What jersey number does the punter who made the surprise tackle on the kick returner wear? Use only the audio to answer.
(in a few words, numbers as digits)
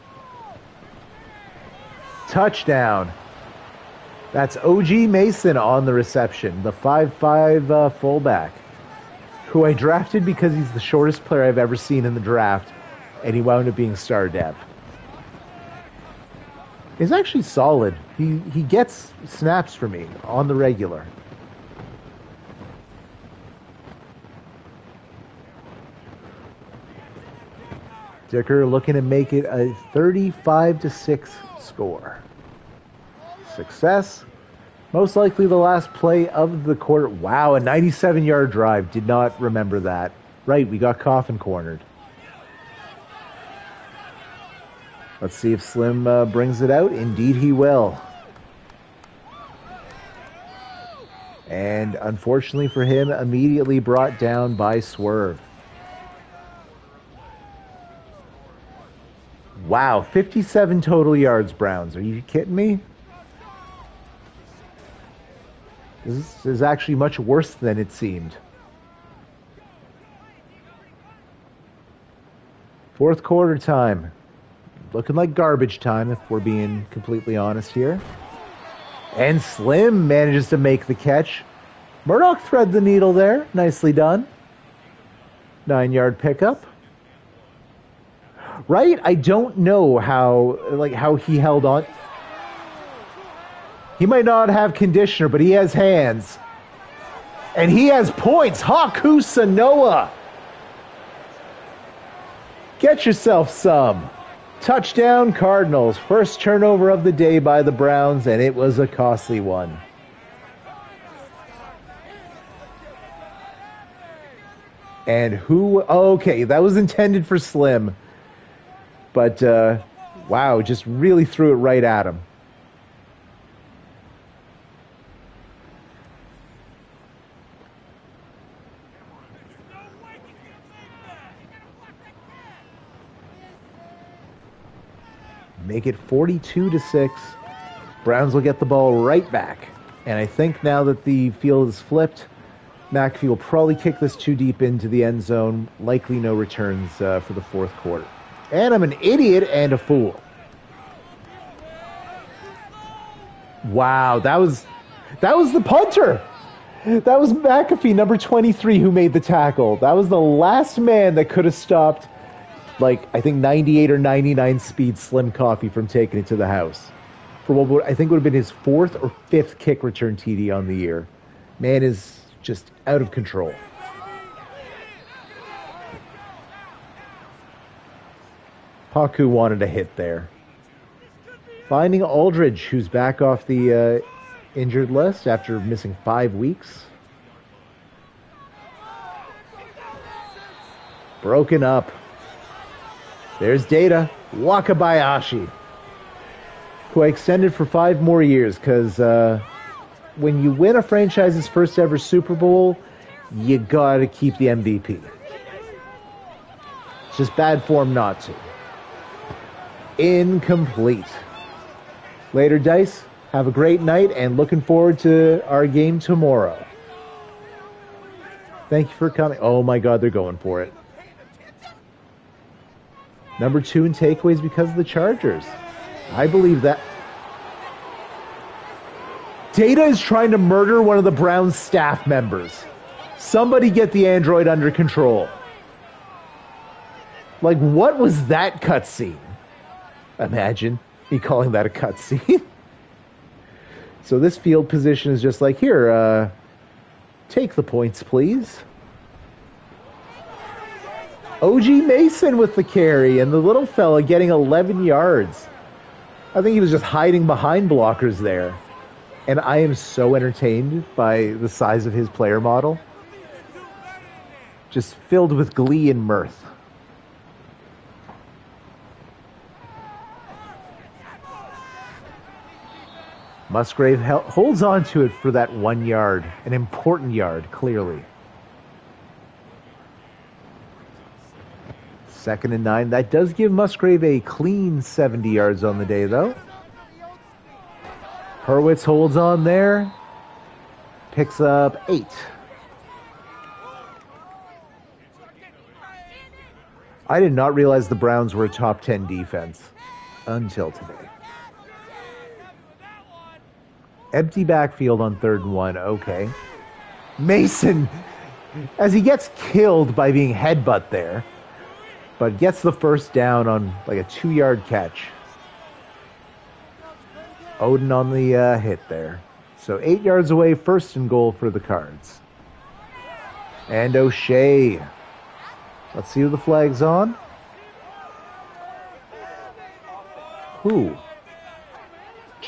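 23.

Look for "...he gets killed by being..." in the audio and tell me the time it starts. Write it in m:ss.
5:08.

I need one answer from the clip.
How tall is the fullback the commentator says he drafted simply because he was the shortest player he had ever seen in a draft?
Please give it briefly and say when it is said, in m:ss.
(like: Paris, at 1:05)
5'5", at 0:06.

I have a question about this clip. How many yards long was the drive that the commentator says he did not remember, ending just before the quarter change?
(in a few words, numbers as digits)
97.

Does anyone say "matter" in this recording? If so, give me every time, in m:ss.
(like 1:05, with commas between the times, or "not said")
not said.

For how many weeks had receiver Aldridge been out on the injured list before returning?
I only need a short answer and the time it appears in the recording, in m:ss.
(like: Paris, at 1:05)
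5, at 3:06.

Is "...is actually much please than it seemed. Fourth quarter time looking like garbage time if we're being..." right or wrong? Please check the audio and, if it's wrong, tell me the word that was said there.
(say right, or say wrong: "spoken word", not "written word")
wrong: "worse", not "please".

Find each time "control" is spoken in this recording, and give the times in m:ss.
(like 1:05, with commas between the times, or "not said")
2:53, 3:54.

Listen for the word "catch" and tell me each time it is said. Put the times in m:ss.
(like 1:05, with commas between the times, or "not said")
1:20, 5:14.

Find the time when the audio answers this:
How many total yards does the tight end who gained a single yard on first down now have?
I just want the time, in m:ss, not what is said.
4:44.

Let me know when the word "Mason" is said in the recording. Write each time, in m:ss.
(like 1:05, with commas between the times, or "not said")
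0:04, 4:11, 5:07.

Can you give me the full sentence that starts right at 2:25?
Likely no returns uh, for the fourth quarter.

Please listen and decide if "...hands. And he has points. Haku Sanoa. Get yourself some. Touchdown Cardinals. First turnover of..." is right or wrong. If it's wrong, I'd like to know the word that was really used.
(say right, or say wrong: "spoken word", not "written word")
right.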